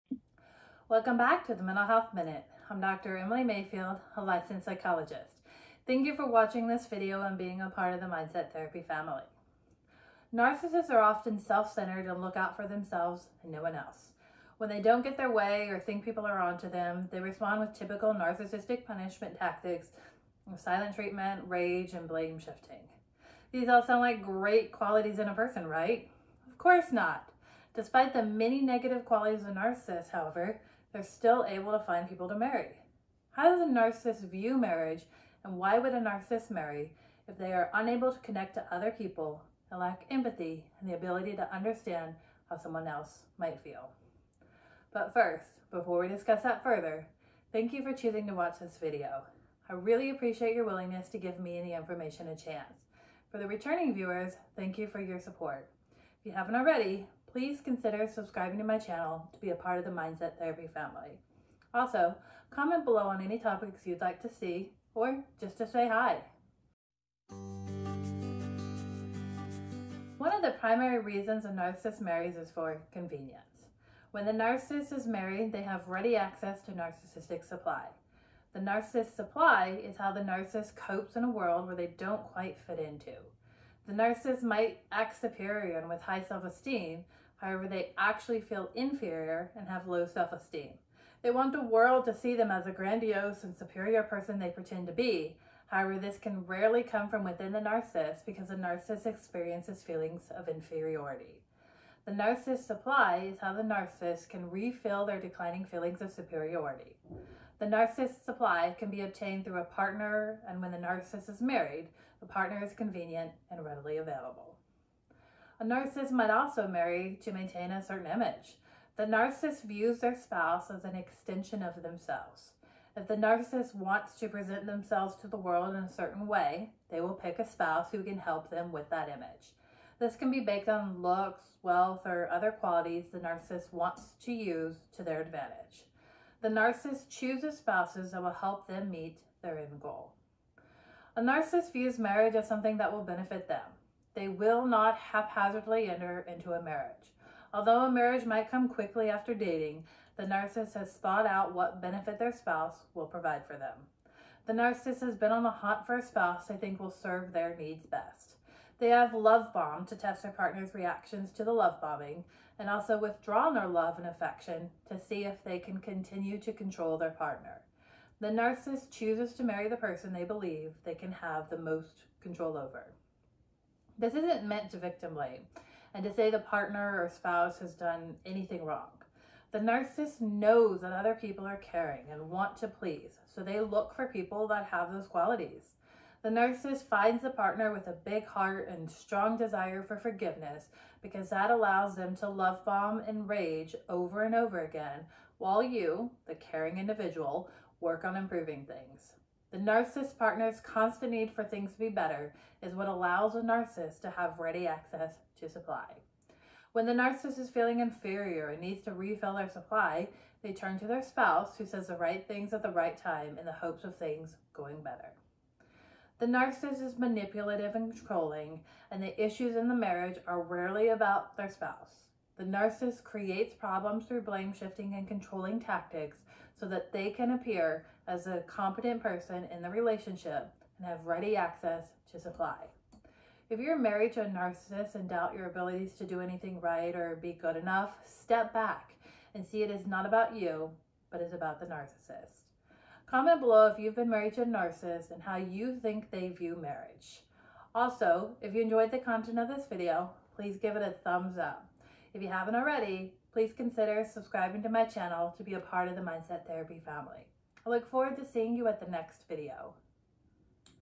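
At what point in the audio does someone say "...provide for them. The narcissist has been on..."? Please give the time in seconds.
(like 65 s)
153 s.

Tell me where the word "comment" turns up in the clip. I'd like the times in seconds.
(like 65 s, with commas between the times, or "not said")
62 s, 243 s.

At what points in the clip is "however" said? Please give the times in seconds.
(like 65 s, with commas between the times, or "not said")
30 s, 87 s, 95 s.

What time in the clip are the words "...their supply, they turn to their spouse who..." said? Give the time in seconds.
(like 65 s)
209 s.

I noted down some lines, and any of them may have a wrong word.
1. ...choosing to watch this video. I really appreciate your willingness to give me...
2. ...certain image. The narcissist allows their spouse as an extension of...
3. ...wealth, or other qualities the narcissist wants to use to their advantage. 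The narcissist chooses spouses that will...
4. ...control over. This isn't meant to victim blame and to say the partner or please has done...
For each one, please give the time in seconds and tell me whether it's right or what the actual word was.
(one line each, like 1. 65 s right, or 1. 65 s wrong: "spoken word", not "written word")
1. 47 s right
2. 117 s wrong: "views", not "allows"
3. 131 s right
4. 172 s wrong: "spouse", not "please".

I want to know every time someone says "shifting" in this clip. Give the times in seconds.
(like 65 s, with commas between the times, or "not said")
22 s, 224 s.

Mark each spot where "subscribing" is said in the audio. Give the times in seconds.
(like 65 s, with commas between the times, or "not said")
58 s, 254 s.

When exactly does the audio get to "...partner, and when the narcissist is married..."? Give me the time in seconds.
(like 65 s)
109 s.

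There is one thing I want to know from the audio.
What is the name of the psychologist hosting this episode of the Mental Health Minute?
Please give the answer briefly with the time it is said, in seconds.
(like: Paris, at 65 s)
Emily Mayfield, at 3 s.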